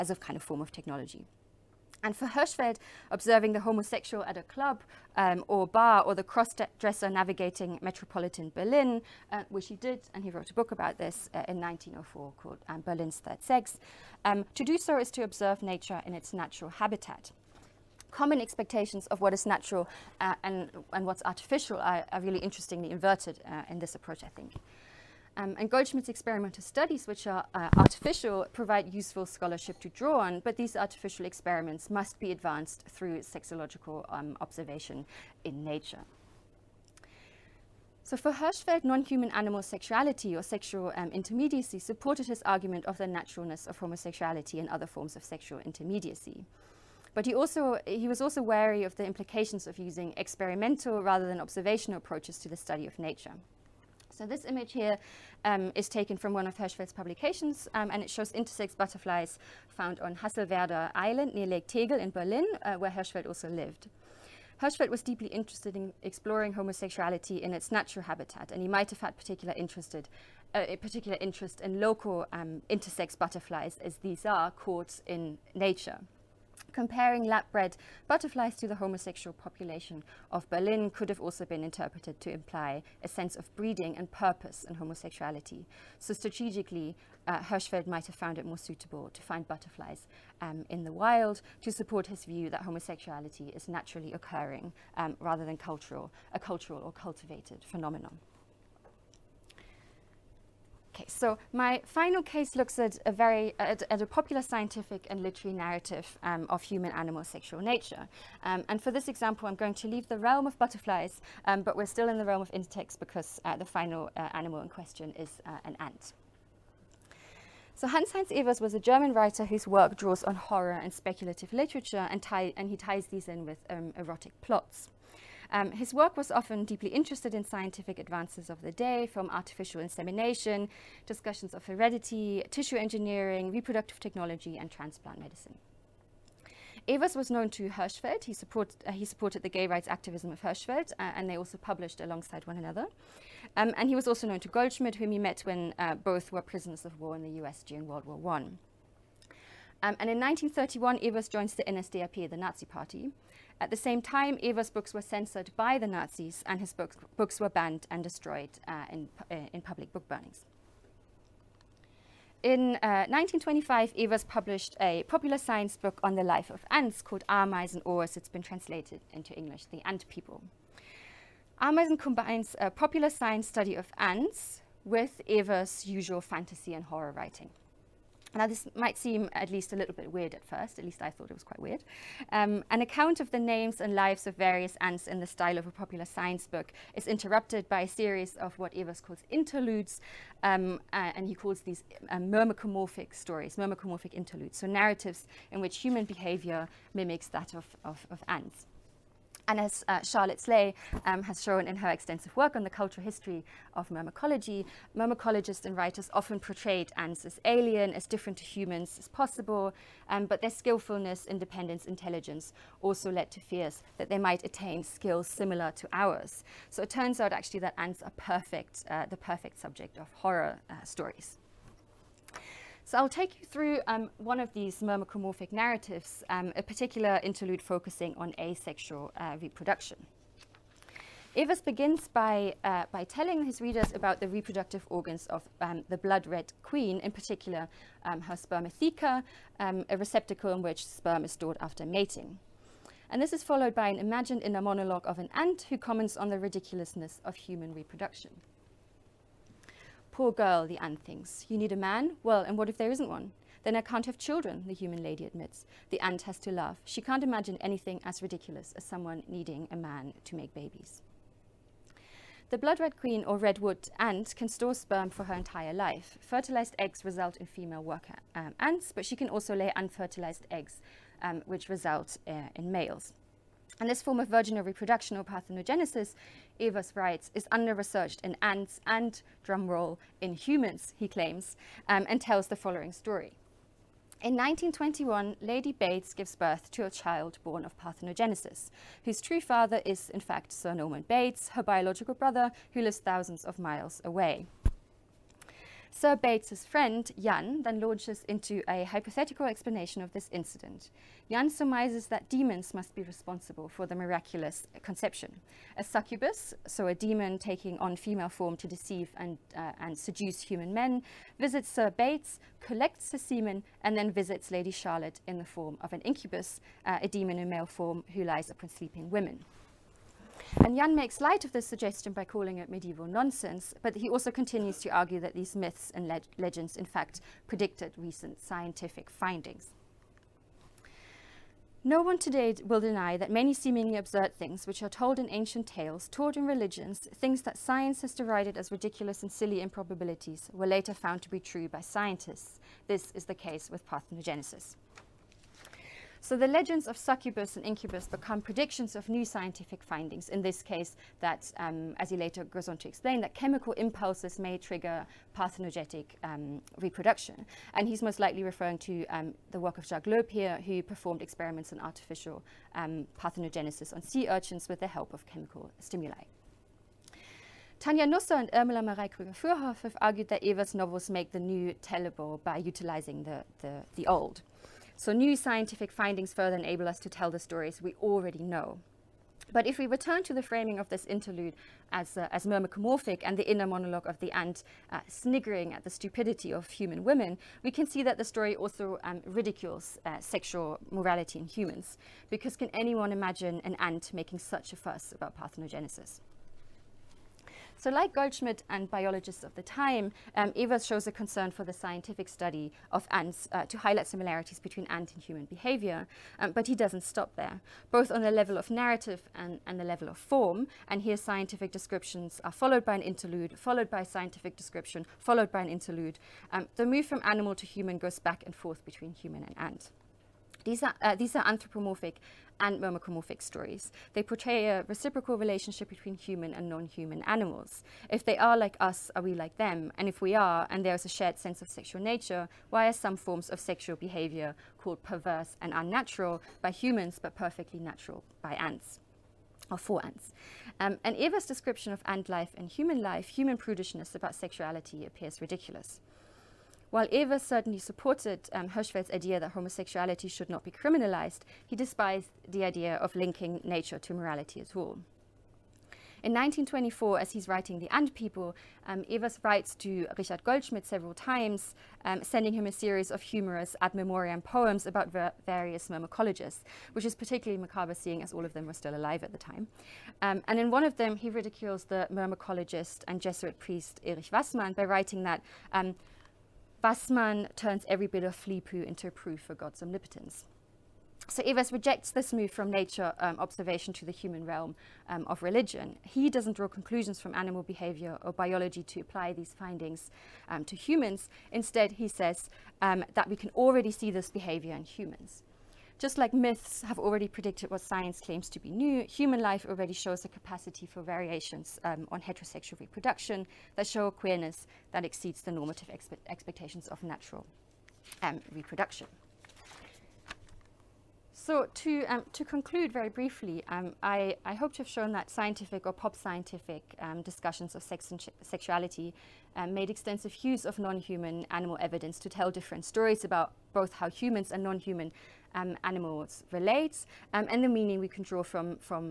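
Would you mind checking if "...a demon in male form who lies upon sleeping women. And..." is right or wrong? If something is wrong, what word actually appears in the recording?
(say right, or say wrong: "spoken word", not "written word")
right.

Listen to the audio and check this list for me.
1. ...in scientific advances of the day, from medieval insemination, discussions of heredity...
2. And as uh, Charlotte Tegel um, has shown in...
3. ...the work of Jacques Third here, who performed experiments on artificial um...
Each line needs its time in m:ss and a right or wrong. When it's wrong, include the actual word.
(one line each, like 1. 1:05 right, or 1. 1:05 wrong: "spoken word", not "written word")
1. 2:07 wrong: "artificial", not "medieval"
2. 3:19 wrong: "Sleigh", not "Tegel"
3. 5:59 wrong: "Loeb", not "Third".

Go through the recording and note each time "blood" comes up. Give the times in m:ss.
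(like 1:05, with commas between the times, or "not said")
3:55, 4:22.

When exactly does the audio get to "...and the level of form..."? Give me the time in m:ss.
6:49.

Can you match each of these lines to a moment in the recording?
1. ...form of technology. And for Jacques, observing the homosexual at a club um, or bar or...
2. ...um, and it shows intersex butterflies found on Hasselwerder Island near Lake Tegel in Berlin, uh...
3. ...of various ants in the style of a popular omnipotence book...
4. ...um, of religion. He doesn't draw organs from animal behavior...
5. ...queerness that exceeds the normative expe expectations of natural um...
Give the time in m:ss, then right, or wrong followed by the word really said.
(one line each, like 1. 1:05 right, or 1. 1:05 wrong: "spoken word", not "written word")
1. 0:00 wrong: "Hirschfeld", not "Jacques"
2. 0:57 right
3. 3:04 wrong: "science", not "omnipotence"
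4. 8:05 wrong: "conclusions", not "organs"
5. 8:24 right.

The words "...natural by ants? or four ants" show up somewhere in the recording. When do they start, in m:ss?
7:17.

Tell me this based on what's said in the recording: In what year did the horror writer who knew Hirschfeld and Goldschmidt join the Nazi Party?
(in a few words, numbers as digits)
1931.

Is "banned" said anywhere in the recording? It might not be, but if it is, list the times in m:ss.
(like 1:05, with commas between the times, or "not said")
2:37.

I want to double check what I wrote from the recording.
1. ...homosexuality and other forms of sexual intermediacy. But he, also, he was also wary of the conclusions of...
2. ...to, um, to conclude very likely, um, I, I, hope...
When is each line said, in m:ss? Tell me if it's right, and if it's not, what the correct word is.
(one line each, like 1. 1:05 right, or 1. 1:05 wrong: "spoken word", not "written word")
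1. 0:43 wrong: "implications", not "conclusions"
2. 8:31 wrong: "briefly", not "likely".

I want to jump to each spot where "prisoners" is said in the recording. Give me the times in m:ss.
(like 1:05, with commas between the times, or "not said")
2:26.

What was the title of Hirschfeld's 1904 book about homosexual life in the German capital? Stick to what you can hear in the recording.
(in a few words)
Berlin's Third Sex.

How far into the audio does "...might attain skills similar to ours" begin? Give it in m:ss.
3:34.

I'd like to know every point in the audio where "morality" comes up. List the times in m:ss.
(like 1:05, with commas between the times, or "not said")
6:30, 7:34.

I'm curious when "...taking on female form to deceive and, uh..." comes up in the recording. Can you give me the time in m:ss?
5:07.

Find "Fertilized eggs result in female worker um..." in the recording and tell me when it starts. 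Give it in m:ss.
4:26.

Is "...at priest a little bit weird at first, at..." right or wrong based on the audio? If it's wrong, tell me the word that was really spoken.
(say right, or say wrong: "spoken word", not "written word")
wrong: "least", not "priest".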